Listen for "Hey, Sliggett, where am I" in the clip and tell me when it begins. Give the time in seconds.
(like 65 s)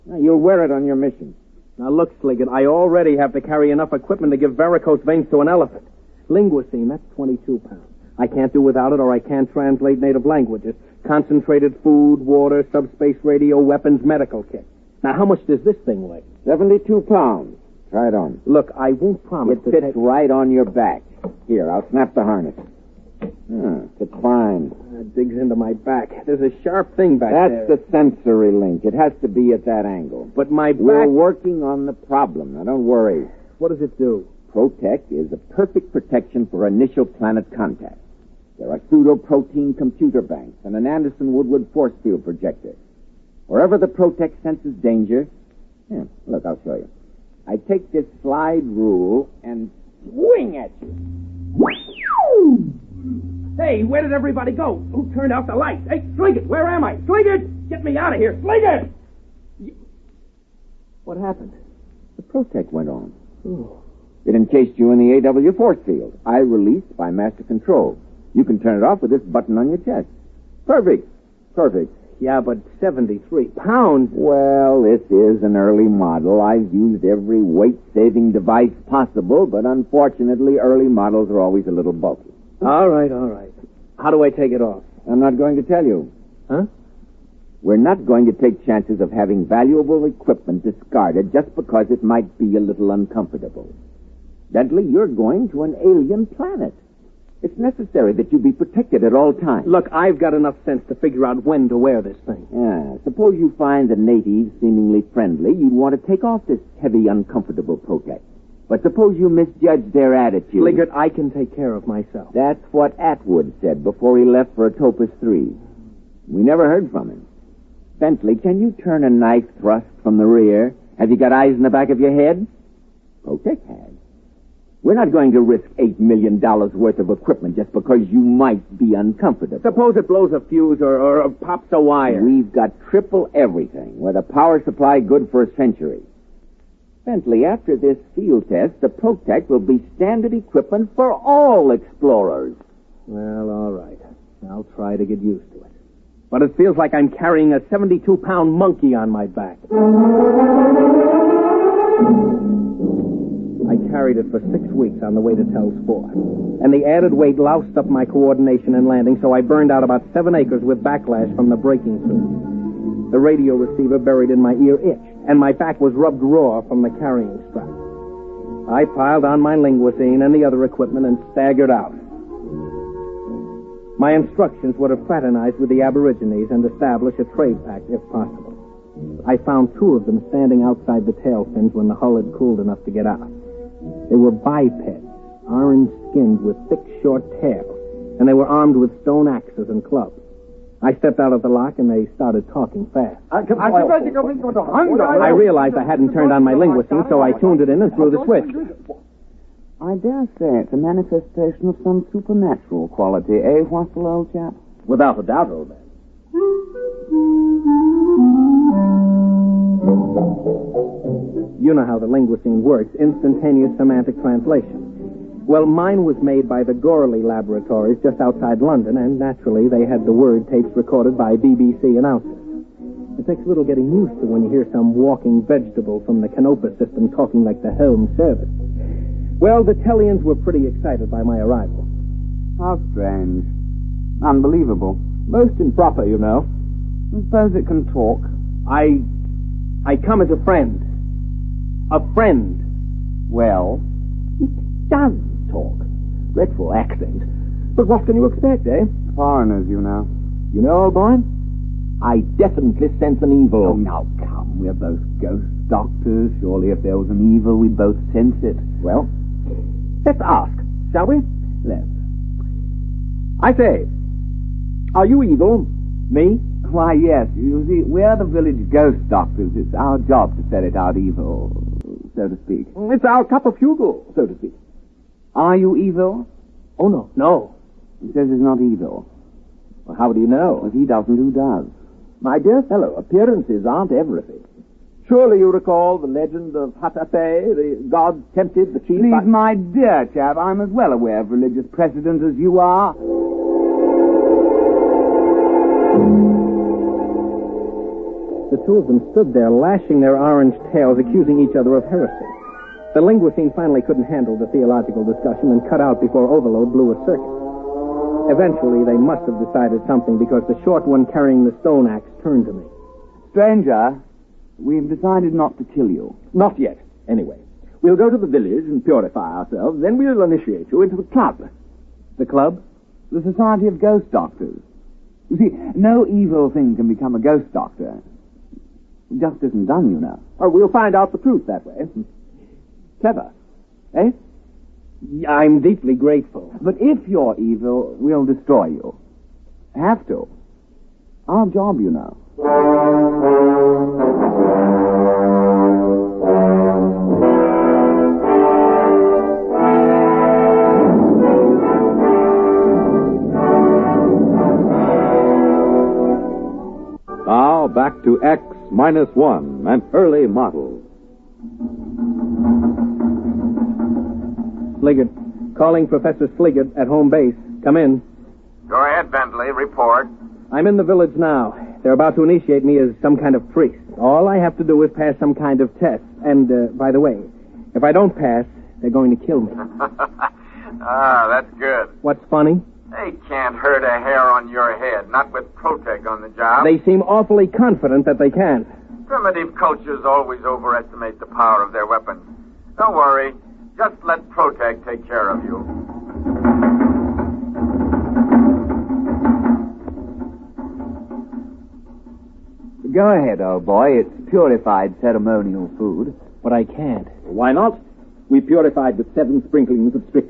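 55 s.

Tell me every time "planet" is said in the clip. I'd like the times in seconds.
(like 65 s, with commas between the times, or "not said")
37 s, 96 s.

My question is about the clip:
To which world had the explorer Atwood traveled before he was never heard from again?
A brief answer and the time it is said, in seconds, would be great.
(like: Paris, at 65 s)
Atopus 3, at 114 s.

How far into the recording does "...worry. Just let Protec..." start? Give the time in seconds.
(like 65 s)
392 s.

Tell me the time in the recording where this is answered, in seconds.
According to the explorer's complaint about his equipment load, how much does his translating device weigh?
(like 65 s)
7 s.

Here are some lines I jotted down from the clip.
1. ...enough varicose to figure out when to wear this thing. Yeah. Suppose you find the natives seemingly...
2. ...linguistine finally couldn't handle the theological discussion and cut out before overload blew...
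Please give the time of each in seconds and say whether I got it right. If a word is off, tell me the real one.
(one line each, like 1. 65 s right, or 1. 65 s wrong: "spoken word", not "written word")
1. 100 s wrong: "sense", not "varicose"
2. 303 s right.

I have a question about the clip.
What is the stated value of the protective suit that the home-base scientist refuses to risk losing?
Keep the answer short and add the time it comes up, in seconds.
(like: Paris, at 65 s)
$8 million, at 125 s.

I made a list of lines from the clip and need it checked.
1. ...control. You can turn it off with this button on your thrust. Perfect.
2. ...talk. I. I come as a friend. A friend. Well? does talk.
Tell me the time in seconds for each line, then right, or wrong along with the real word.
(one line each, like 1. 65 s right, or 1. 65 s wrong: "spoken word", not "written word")
1. 67 s wrong: "chest", not "thrust"
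2. 237 s right.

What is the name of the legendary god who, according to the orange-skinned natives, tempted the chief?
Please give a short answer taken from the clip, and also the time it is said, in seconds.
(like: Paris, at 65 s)
Hatape, at 286 s.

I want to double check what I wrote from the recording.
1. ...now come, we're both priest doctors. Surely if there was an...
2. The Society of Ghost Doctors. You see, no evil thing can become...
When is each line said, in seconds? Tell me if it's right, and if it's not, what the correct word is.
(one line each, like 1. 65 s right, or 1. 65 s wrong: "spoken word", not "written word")
1. 253 s wrong: "ghost", not "priest"
2. 323 s right.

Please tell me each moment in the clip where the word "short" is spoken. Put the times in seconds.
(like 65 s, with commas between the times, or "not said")
187 s, 310 s.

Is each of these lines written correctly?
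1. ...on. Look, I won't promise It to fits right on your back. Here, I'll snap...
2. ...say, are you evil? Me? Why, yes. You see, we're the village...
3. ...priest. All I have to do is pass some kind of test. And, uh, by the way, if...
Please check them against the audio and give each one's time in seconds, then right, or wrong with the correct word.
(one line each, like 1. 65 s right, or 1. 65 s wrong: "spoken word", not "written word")
1. 18 s right
2. 263 s right
3. 373 s right.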